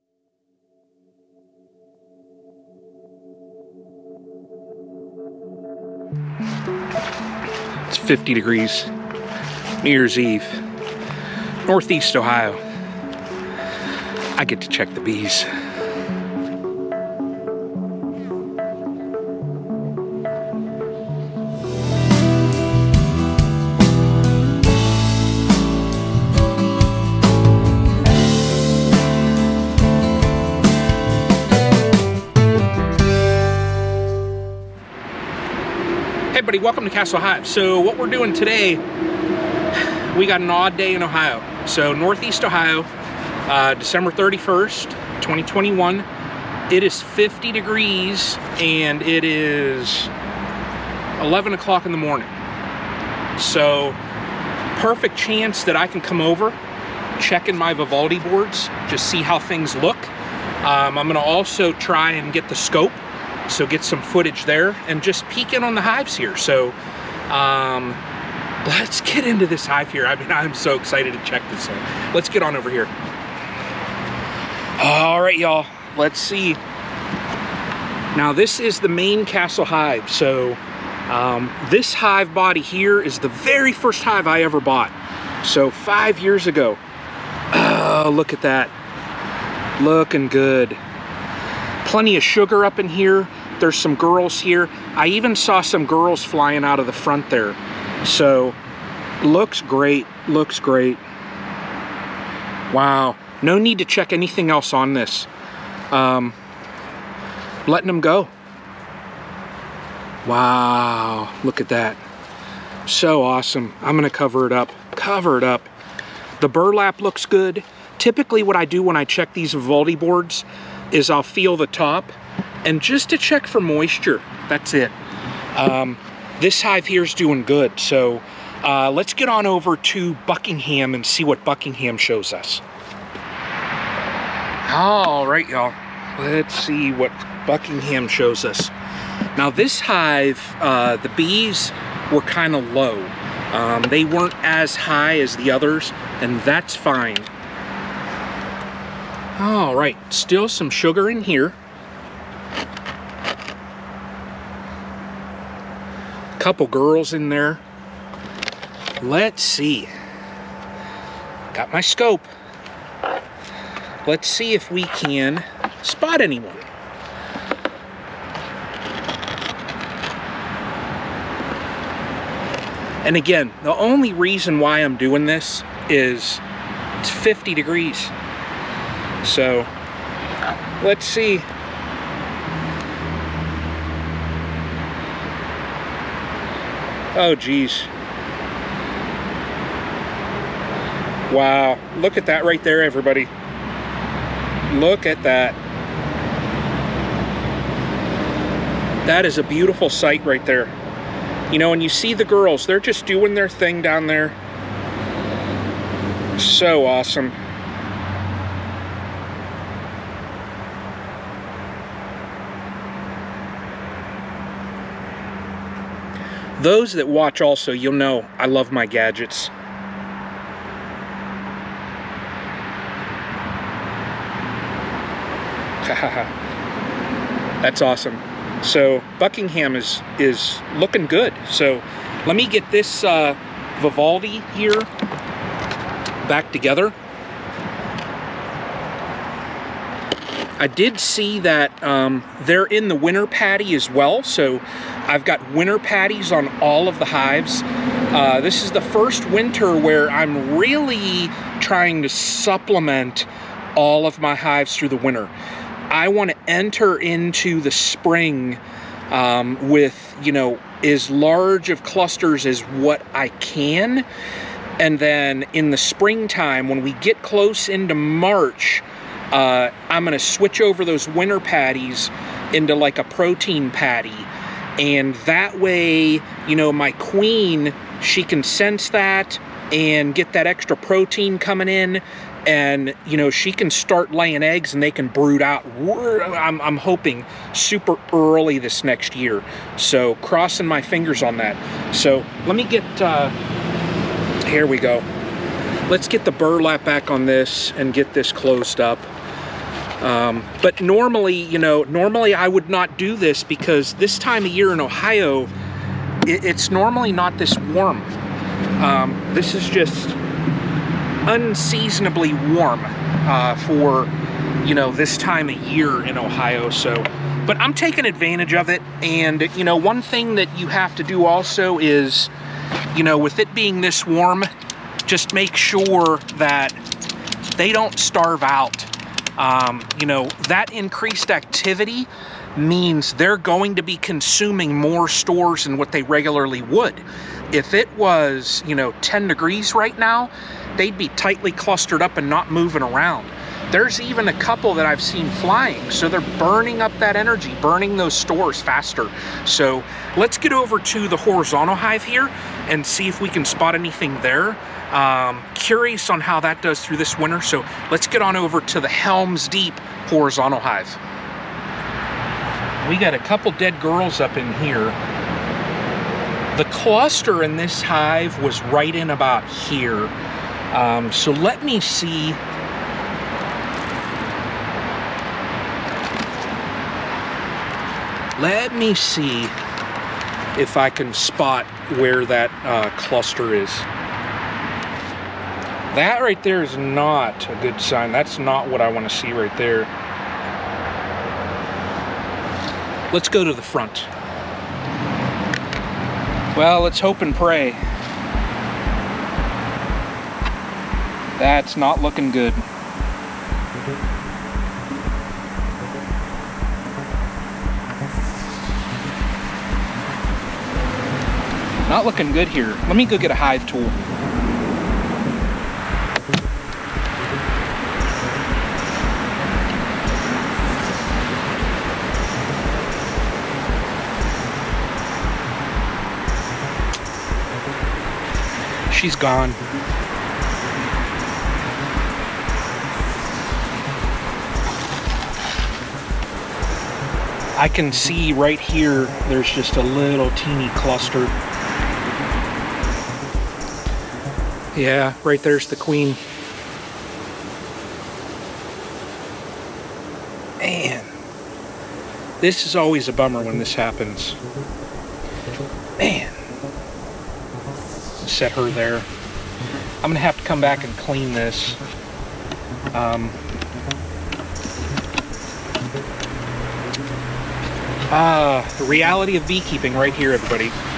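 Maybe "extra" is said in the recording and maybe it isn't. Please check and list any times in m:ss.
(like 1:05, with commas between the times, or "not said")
4:40.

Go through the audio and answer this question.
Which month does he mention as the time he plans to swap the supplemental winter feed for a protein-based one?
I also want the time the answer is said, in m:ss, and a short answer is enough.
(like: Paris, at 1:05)
March, at 4:27.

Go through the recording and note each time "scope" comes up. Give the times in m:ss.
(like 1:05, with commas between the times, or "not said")
1:02, 2:41.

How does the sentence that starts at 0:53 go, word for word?
So perfect chance that I can come over, check in my Vivaldi boards, just see how things look.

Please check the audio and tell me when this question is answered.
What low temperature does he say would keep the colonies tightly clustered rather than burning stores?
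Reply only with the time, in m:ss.
5:39.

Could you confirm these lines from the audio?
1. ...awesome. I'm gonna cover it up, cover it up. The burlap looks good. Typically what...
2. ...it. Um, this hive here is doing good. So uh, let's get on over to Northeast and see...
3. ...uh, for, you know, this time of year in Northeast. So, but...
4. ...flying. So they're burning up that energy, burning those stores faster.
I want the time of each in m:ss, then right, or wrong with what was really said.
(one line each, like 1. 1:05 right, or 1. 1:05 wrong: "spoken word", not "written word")
1. 1:53 right
2. 2:04 wrong: "Buckingham", not "Northeast"
3. 5:12 wrong: "Ohio", not "Northeast"
4. 5:45 right.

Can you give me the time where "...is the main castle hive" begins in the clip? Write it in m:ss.
1:18.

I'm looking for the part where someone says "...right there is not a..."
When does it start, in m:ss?
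6:26.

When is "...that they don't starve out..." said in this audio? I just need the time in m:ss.
5:26.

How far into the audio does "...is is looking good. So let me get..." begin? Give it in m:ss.
3:49.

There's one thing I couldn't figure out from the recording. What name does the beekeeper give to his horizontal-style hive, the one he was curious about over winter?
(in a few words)
Helms Deep.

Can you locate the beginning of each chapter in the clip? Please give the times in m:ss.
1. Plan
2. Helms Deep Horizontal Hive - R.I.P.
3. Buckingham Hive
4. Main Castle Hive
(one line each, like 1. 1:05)
1. 0:35
2. 6:02
3. 2:13
4. 1:14.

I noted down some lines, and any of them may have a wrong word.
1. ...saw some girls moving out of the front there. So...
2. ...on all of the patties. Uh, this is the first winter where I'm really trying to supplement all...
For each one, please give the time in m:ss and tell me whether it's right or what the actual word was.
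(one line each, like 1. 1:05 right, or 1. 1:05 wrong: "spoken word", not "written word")
1. 1:35 wrong: "flying", not "moving"
2. 4:06 wrong: "hives", not "patties".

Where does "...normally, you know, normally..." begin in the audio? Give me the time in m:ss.
5:00.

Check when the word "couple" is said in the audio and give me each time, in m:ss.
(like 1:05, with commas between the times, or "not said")
2:36, 5:44, 6:03.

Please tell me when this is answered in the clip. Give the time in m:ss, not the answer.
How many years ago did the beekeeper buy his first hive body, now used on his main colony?
1:25.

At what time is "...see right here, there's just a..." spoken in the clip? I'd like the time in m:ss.
7:17.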